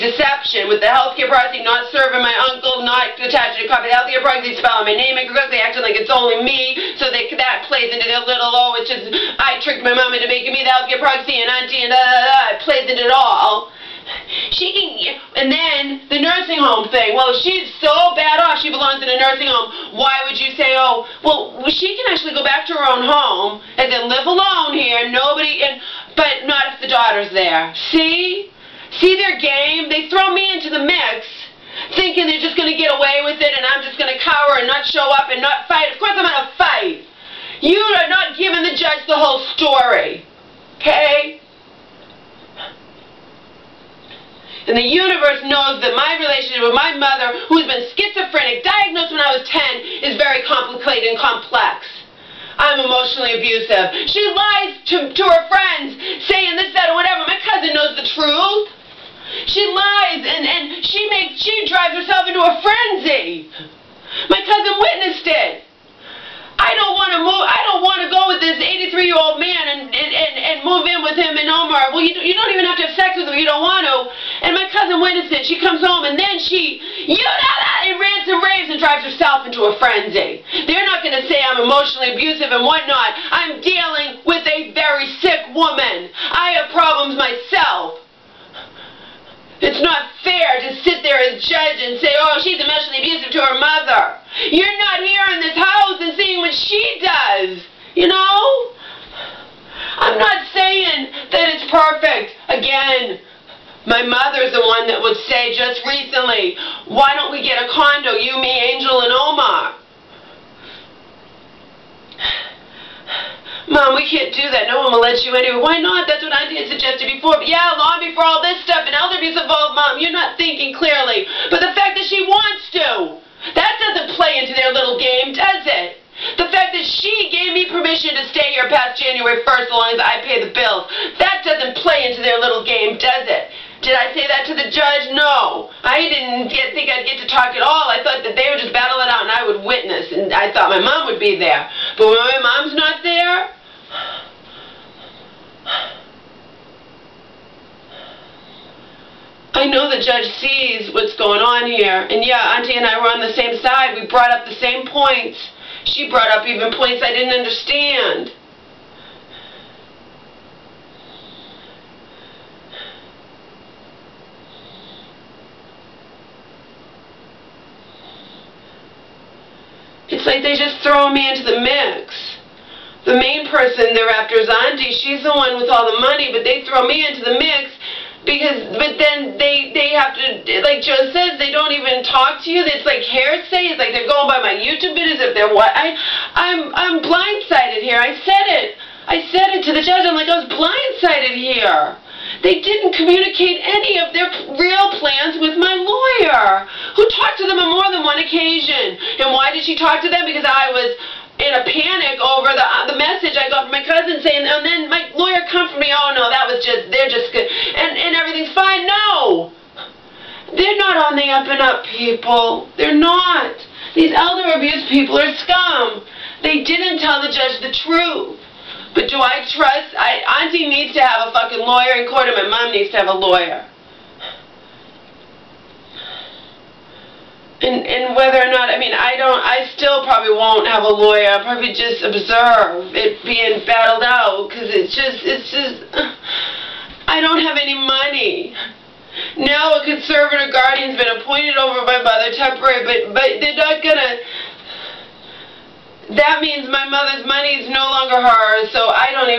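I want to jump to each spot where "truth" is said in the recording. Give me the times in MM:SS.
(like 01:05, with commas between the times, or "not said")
00:58, 03:37.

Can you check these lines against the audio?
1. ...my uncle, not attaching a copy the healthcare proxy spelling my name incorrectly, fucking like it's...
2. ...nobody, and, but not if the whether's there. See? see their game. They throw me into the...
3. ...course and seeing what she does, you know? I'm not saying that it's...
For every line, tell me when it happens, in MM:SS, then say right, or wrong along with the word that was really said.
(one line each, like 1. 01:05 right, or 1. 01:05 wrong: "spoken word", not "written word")
1. 00:02 wrong: "acting", not "fucking"
2. 00:25 wrong: "daughter", not "whether"
3. 01:35 wrong: "house", not "course".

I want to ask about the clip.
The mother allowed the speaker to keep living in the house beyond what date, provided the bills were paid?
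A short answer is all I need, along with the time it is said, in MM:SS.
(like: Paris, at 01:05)
January 1st, at 02:09.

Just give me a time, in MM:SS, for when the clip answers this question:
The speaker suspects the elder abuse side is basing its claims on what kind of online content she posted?
03:04.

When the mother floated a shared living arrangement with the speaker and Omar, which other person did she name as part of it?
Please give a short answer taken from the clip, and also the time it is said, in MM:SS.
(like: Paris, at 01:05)
Angel, at 01:48.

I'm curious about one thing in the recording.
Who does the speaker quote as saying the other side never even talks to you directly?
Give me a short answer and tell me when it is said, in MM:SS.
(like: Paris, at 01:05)
Joe, at 03:00.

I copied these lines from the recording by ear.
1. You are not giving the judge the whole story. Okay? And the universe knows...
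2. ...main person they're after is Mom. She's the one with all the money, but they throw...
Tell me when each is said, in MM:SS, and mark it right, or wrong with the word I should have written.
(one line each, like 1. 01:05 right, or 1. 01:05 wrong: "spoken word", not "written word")
1. 00:37 right
2. 02:53 wrong: "Auntie", not "Mom".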